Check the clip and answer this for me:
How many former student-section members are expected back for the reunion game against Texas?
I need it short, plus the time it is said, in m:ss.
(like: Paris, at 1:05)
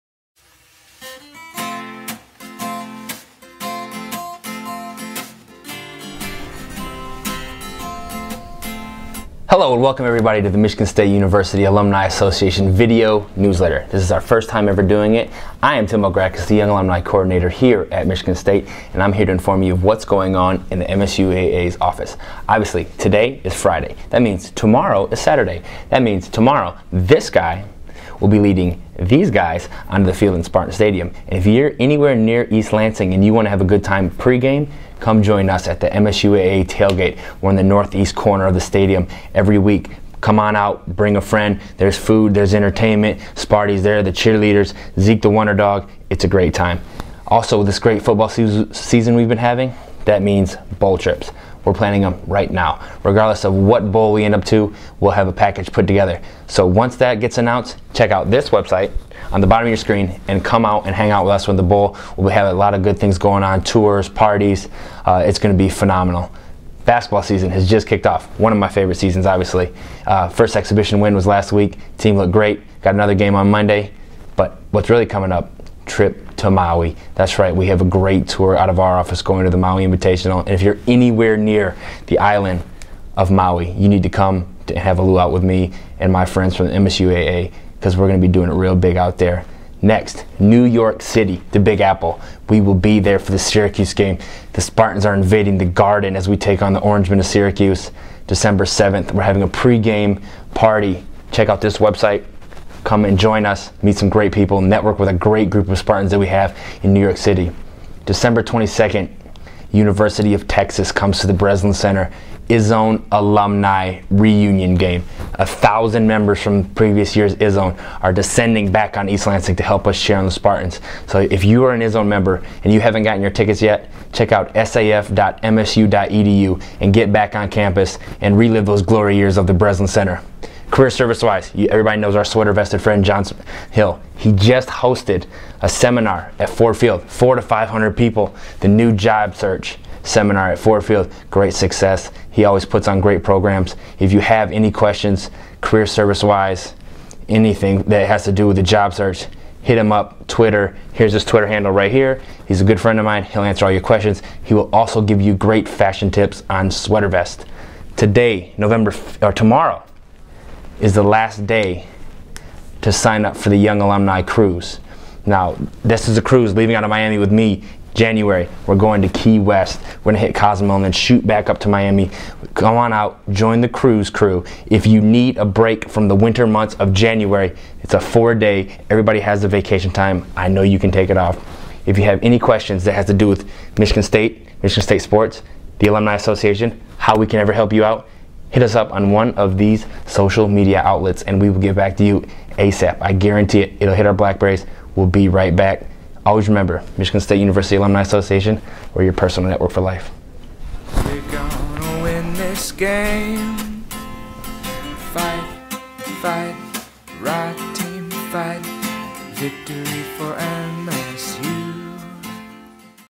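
1000, at 1:55.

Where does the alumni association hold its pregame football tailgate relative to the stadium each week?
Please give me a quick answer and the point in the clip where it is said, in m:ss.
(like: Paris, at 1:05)
Northeast corner, at 0:37.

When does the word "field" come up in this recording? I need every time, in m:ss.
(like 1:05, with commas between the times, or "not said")
0:30, 2:16, 2:20.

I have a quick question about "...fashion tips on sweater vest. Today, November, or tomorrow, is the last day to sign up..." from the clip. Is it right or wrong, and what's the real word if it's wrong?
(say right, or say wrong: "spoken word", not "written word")
right.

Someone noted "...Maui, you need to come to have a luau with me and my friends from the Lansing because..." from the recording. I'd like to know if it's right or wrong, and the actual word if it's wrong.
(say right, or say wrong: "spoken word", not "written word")
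wrong: "MSUAA", not "Lansing".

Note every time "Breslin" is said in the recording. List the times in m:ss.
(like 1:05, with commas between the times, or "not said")
1:51, 2:09.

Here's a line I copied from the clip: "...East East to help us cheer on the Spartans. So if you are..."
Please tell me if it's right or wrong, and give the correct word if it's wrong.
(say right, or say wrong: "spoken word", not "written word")
wrong: "Lansing", not "East".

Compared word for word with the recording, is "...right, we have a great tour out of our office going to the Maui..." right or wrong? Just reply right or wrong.
right.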